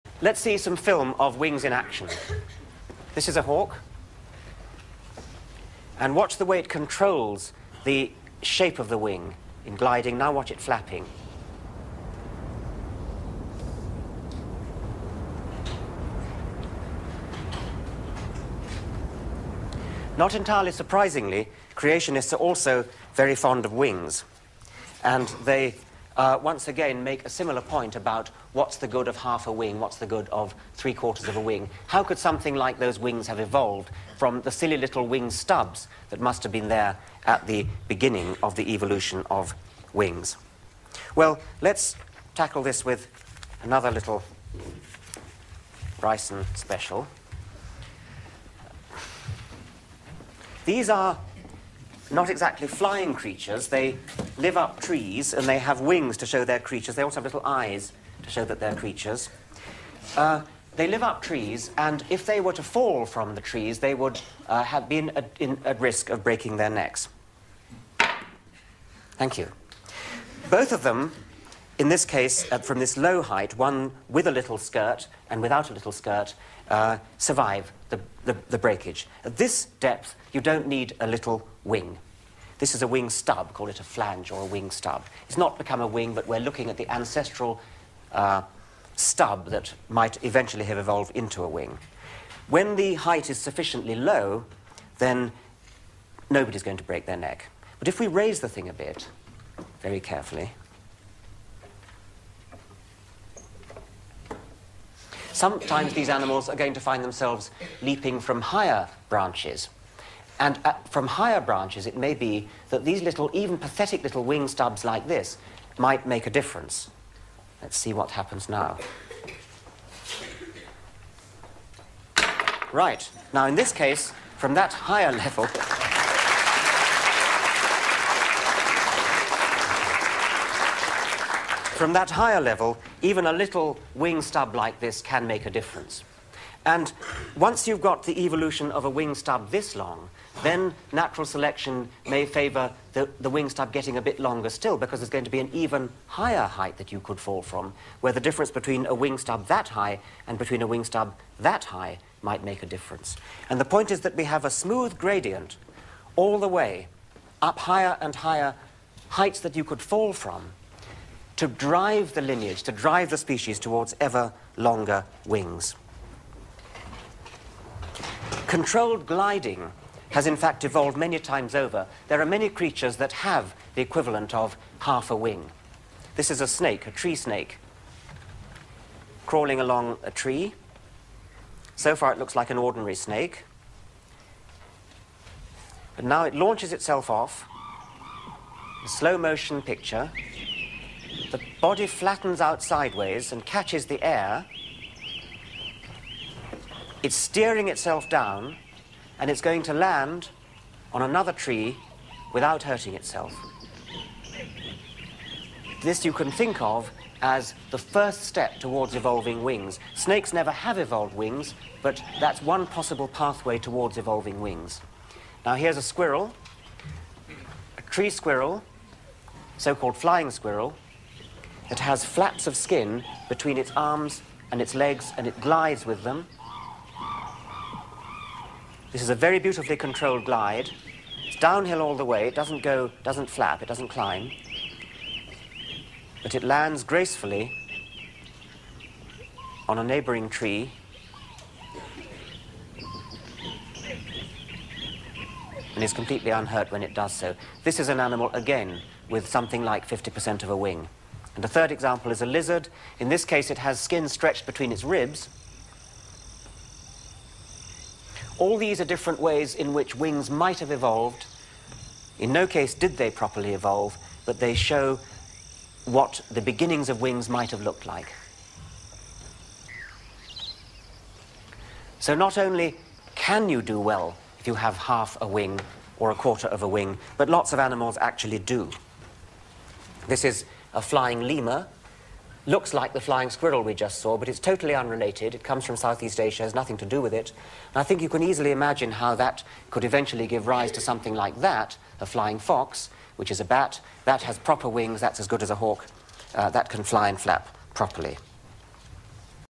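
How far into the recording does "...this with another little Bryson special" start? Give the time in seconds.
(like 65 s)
42 s.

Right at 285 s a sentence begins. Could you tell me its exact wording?
It comes from Southeast Asia, has nothing to do with it.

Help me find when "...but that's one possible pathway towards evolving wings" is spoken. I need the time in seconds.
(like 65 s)
211 s.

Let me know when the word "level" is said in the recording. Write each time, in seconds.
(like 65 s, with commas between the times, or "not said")
125 s, 132 s.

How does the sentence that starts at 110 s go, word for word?
And uh, from higher branches, it may be that these little, even pathetic little wing stubs like this might make a difference.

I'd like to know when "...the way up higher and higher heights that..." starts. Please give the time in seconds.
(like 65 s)
156 s.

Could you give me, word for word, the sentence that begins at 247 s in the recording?
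This is an animal, again, with something like 50% of a wing.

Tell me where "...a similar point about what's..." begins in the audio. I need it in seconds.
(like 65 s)
27 s.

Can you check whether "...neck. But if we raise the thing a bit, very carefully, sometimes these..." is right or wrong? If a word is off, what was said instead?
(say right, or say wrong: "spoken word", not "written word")
right.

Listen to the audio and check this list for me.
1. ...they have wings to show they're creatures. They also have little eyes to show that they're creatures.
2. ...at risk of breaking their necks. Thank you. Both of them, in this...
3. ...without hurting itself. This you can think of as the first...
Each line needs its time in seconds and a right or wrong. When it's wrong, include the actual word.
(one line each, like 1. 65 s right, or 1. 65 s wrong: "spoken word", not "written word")
1. 55 s right
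2. 65 s right
3. 202 s right.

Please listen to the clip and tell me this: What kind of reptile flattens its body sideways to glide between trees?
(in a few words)
tree snake.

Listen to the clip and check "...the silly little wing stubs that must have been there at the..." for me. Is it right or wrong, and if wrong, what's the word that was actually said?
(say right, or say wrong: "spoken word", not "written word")
right.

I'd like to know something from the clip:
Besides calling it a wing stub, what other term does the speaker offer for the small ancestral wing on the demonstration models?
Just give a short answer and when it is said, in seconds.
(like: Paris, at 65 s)
flange, at 83 s.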